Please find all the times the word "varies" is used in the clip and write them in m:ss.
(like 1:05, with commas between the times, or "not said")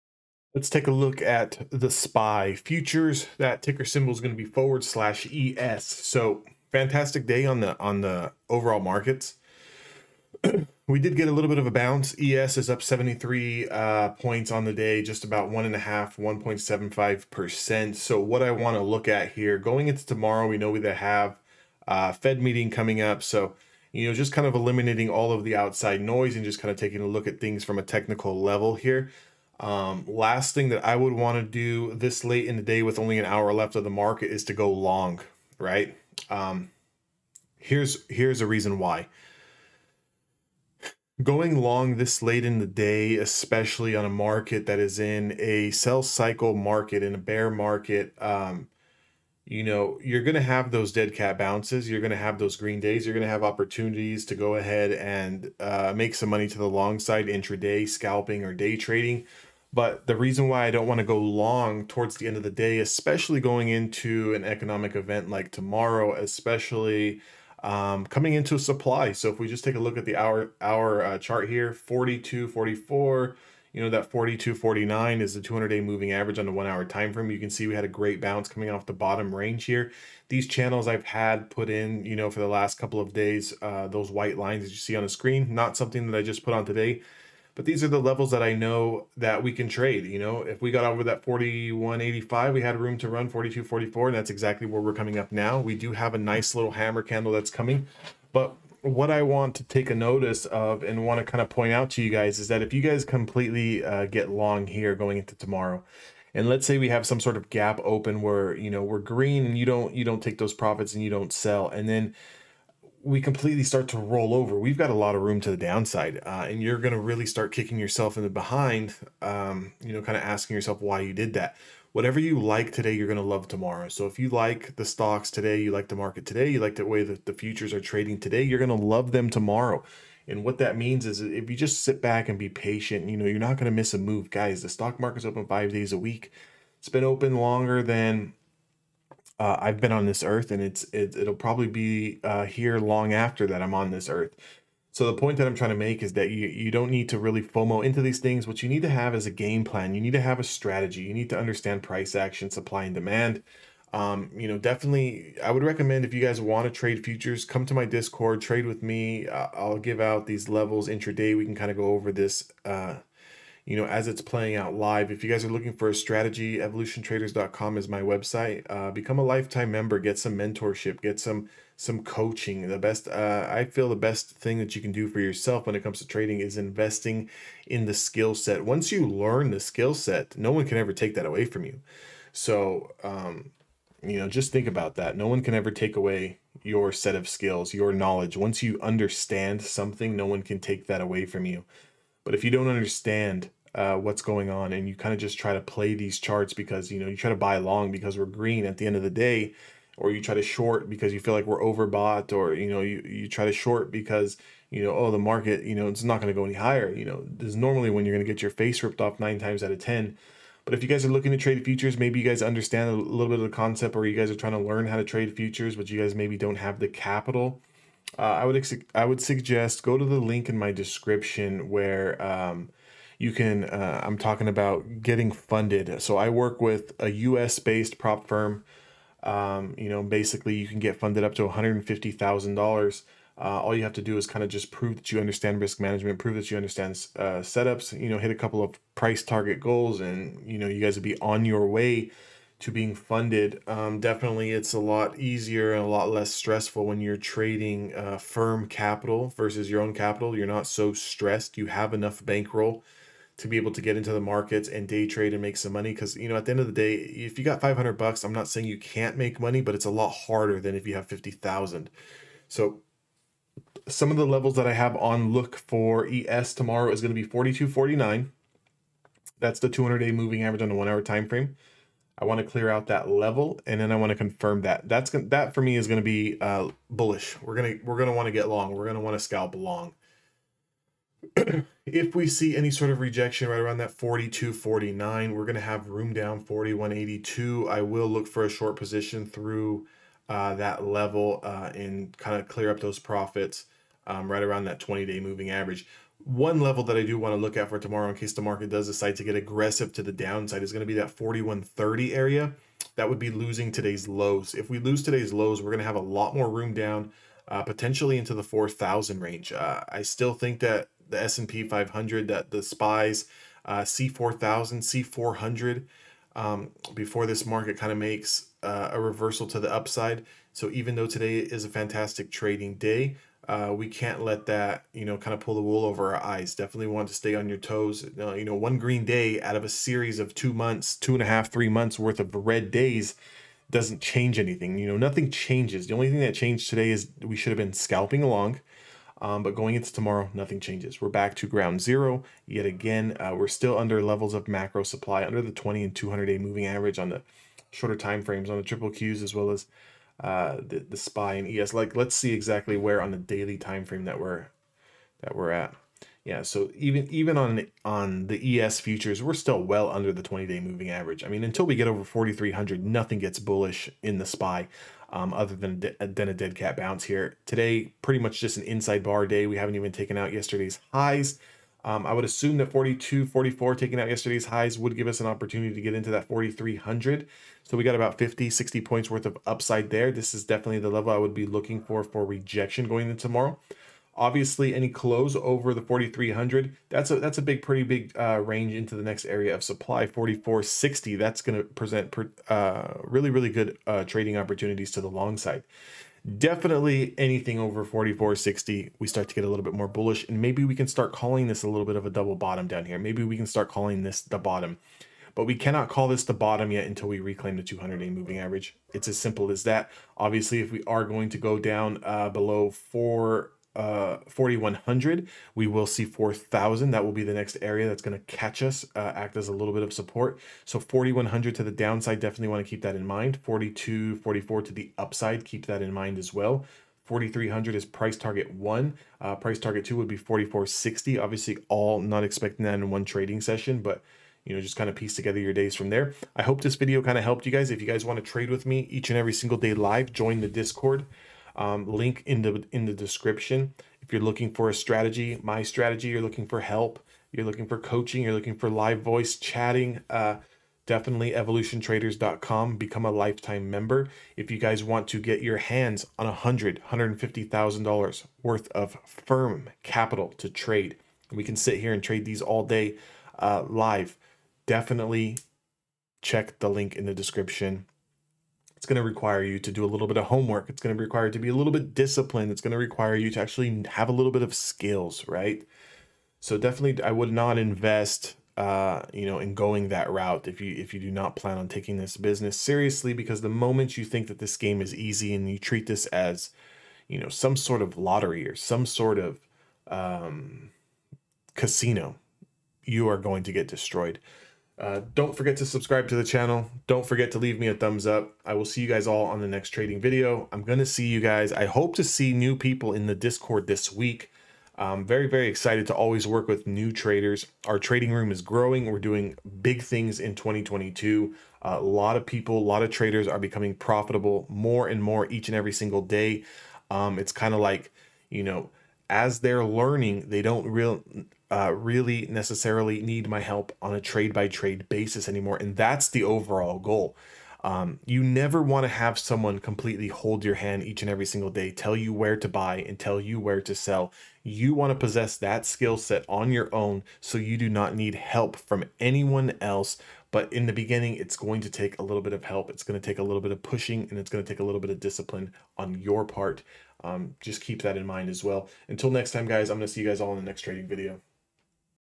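not said.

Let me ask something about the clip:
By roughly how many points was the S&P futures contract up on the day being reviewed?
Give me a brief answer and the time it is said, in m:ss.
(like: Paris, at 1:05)
73, at 0:12.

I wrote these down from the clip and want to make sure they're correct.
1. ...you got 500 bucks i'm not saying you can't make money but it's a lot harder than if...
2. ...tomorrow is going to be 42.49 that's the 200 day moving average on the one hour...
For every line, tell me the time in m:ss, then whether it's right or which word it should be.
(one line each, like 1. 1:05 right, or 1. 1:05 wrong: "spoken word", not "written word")
1. 4:17 right
2. 4:26 right.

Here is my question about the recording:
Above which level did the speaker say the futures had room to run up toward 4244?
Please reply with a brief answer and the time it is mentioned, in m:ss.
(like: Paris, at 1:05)
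4185, at 1:31.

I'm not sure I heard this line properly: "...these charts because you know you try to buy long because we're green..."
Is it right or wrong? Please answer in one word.
right.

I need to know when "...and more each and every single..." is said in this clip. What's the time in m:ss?
8:34.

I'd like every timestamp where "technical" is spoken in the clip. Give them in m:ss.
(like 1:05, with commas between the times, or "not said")
0:27.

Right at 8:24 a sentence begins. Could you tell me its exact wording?
I'm very, very excited to always work with new traders.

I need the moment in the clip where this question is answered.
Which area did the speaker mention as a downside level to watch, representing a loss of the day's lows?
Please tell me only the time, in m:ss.
5:01.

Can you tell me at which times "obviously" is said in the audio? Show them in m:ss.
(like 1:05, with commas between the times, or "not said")
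6:24, 6:50, 7:11.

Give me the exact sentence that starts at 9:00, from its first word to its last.
But in the beginning, it's going to take a little bit of help.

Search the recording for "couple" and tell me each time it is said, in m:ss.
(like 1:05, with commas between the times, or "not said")
1:22, 3:58.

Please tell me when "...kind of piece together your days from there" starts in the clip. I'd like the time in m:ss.
7:14.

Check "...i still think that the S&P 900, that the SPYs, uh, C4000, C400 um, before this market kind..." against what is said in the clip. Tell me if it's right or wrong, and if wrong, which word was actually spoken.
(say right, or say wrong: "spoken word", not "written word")
wrong: "500", not "900".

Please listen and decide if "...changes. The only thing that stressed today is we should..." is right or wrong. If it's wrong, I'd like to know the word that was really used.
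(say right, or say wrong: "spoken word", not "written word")
wrong: "changed", not "stressed".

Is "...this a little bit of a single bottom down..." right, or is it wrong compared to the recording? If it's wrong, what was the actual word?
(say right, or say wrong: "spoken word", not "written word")
wrong: "double", not "single".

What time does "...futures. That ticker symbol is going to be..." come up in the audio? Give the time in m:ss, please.
0:02.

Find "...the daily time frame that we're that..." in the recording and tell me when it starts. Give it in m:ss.
5:53.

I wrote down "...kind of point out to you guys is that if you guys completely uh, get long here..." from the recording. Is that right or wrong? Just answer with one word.
right.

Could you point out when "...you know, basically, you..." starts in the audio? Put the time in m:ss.
3:49.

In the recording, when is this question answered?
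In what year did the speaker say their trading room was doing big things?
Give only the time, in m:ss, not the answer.
8:30.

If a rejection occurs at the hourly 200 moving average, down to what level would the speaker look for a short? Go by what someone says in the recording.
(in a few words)
4182.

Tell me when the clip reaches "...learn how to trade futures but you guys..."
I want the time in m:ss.
3:34.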